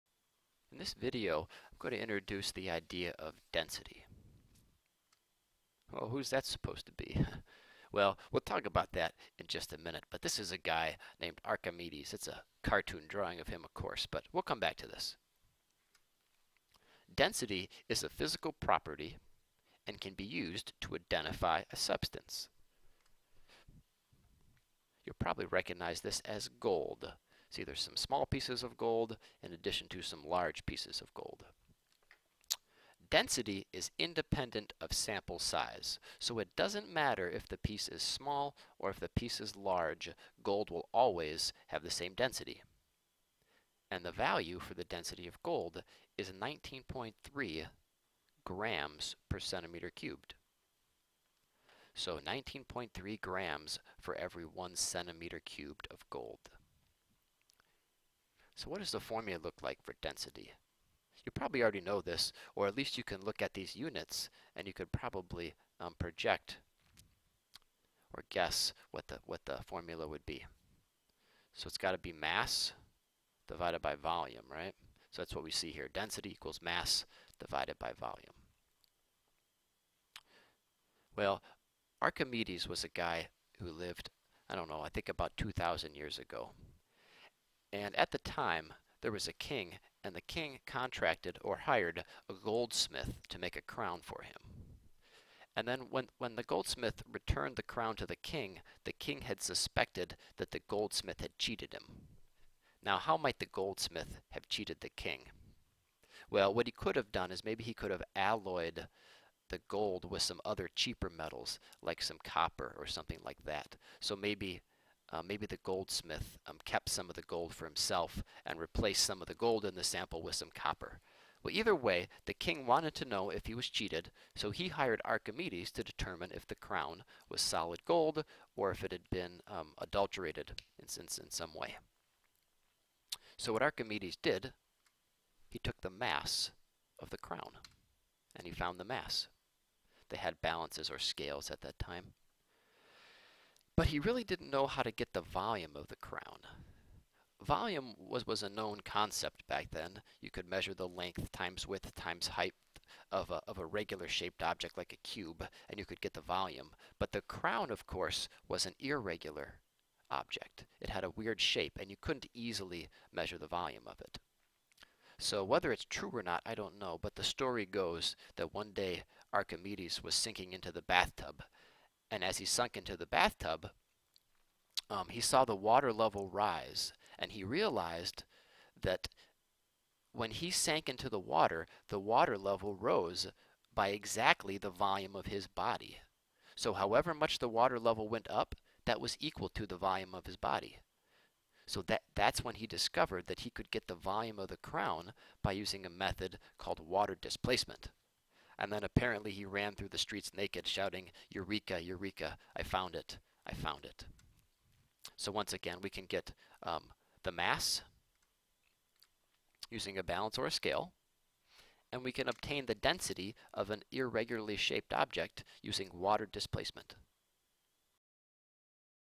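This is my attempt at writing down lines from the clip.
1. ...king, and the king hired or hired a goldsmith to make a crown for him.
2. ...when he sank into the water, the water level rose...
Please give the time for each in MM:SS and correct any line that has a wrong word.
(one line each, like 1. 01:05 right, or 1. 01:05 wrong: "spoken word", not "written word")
1. 01:29 wrong: "contracted", not "hired"
2. 03:00 right.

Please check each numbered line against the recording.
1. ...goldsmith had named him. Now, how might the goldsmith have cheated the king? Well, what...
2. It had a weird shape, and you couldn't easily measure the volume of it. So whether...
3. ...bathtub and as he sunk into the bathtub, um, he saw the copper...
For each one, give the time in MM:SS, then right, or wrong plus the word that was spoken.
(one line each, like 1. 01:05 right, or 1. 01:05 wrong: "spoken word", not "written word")
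1. 01:40 wrong: "cheated", not "named"
2. 02:40 right
3. 02:50 wrong: "water", not "copper".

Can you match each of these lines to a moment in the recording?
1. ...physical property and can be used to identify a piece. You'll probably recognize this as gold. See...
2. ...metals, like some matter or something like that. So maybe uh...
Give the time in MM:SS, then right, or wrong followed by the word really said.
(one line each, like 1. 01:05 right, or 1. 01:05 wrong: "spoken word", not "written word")
1. 00:18 wrong: "substance", not "piece"
2. 01:51 wrong: "copper", not "matter".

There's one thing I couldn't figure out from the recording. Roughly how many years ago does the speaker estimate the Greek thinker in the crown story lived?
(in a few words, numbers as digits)
2,000 years.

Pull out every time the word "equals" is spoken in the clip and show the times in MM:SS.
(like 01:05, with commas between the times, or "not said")
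01:16, 03:09.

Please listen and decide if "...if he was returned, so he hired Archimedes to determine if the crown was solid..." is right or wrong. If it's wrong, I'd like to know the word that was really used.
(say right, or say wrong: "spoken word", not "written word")
wrong: "cheated", not "returned".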